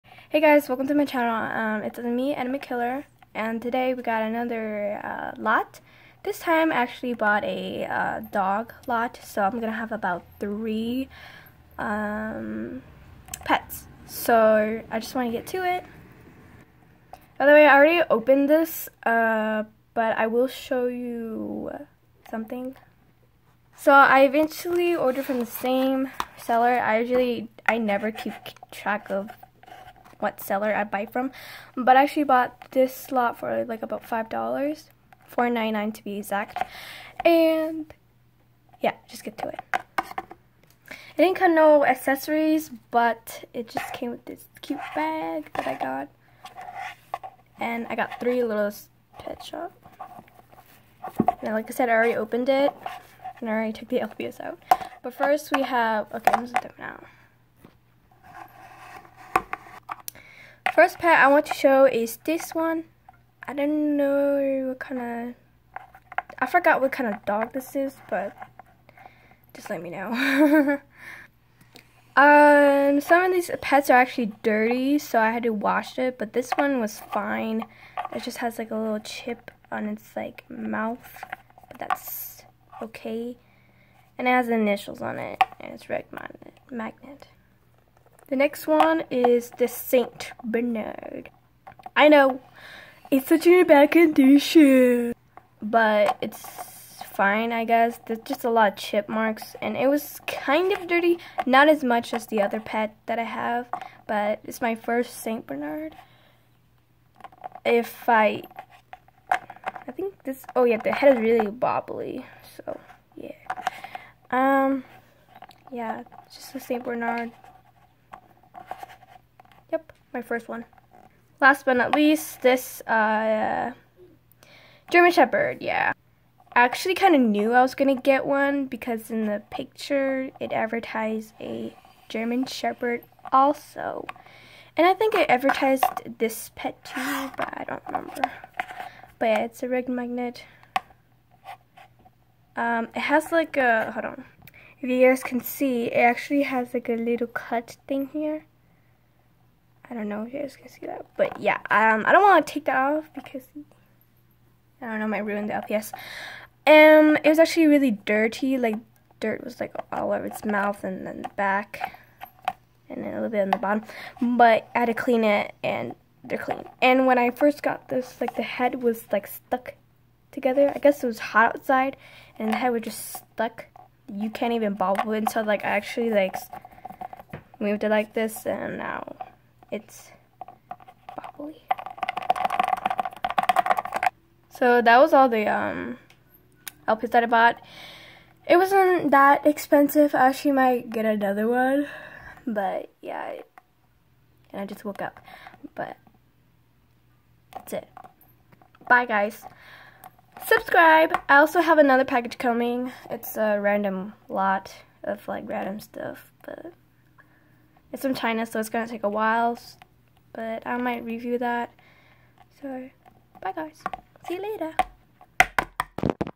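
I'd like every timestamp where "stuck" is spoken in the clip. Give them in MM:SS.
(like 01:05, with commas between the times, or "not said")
02:49, 02:53.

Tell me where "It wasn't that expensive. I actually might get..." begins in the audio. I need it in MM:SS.
03:08.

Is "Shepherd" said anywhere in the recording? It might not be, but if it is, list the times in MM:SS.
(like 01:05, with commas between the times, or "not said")
02:05, 02:12.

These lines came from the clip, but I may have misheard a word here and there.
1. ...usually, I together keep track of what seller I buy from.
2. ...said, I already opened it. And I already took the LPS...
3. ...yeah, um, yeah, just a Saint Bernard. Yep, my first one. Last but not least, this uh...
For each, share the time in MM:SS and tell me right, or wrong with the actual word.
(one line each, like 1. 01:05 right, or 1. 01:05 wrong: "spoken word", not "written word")
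1. 00:26 wrong: "never", not "together"
2. 00:51 right
3. 01:53 right.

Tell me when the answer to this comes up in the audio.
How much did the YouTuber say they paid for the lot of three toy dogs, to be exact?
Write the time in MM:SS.
00:35.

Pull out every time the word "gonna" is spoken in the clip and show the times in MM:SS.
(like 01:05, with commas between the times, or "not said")
00:09, 00:56.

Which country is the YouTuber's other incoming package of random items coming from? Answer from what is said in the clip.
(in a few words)
China.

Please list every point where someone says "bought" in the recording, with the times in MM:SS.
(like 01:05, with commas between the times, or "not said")
00:07, 00:32, 03:07.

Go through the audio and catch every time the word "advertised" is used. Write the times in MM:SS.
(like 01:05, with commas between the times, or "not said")
02:10, 02:15.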